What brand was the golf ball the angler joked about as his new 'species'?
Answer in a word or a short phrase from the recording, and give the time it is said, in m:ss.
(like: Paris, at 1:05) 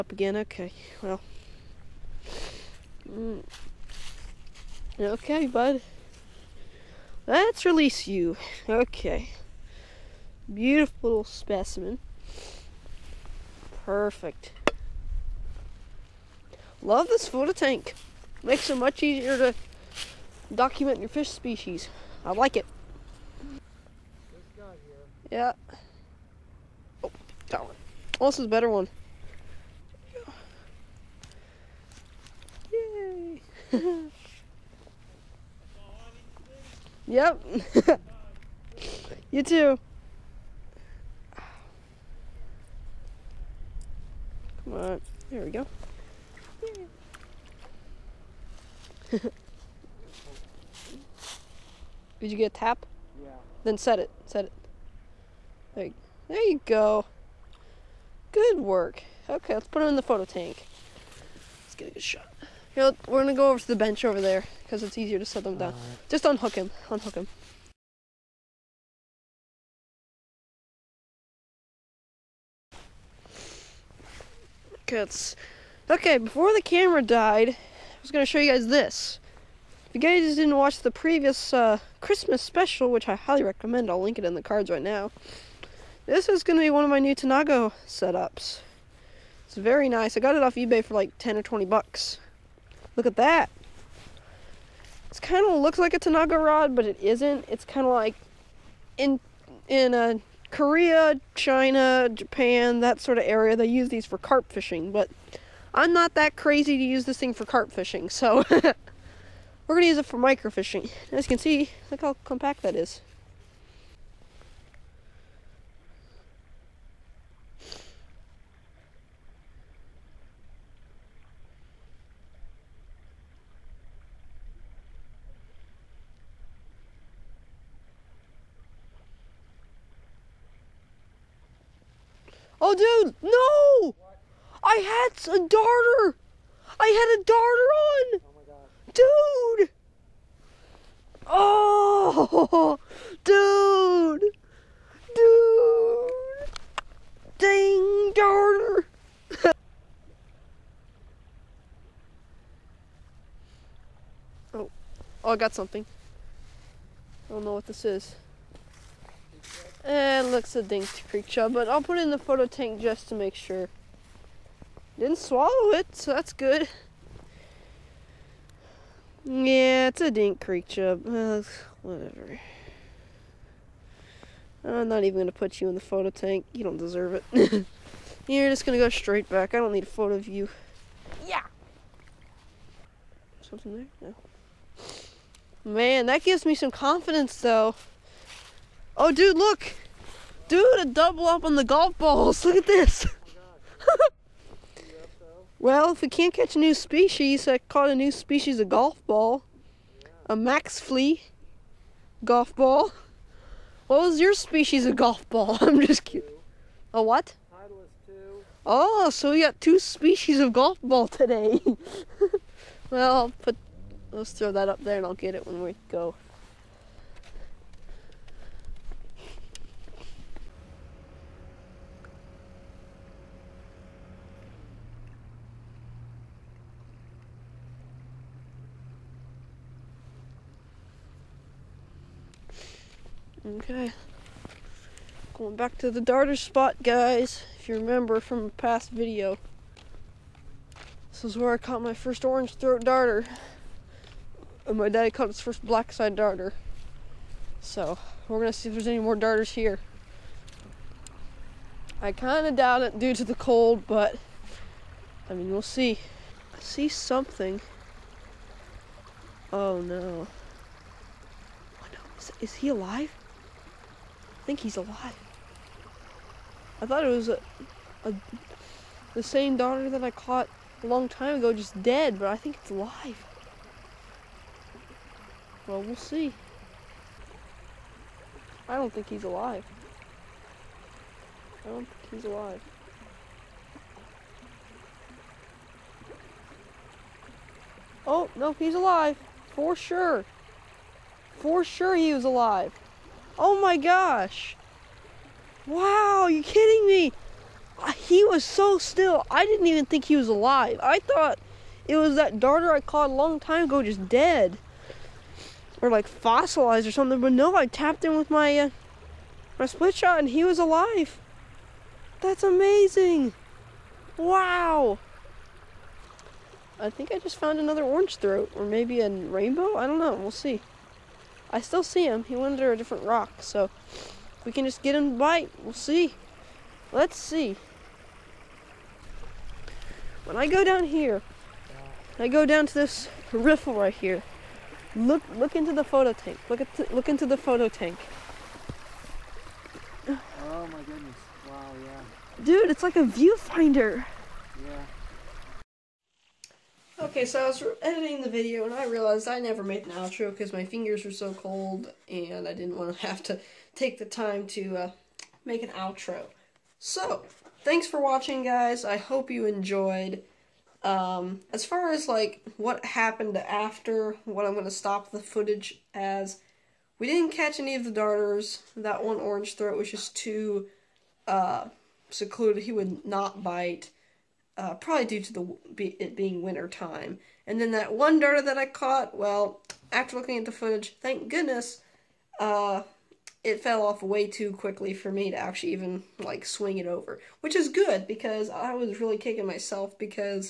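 Maxfli, at 3:20.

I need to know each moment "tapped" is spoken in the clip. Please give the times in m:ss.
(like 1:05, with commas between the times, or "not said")
5:07.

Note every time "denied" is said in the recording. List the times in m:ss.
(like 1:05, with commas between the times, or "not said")
not said.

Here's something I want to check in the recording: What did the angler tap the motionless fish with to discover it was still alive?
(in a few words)
split shot.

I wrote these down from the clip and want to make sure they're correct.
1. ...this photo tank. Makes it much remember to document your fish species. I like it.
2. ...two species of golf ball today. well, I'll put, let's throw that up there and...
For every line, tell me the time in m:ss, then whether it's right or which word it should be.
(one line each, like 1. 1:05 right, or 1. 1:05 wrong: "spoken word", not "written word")
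1. 0:17 wrong: "easier", not "remember"
2. 3:29 right.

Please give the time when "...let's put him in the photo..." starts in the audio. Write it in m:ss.
0:59.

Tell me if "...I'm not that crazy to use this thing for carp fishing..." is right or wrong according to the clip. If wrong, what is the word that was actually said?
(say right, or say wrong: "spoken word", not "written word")
right.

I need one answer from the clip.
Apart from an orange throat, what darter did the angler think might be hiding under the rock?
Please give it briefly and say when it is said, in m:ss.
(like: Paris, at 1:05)
rainbow, at 5:19.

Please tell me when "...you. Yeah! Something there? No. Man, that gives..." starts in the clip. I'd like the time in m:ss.
3:00.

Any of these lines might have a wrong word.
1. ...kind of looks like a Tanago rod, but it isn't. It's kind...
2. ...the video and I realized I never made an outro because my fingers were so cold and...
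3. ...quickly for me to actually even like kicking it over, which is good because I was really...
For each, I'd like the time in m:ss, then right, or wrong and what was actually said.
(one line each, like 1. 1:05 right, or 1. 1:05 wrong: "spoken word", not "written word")
1. 1:35 right
2. 5:48 right
3. 6:24 wrong: "swing", not "kicking".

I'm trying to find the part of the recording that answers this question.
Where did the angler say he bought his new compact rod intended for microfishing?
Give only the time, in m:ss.
1:30.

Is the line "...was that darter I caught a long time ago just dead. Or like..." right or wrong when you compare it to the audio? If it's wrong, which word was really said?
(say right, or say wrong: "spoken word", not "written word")
right.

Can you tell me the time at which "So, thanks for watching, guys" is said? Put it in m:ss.
5:56.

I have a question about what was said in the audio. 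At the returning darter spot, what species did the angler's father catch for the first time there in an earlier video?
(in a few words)
black side darter.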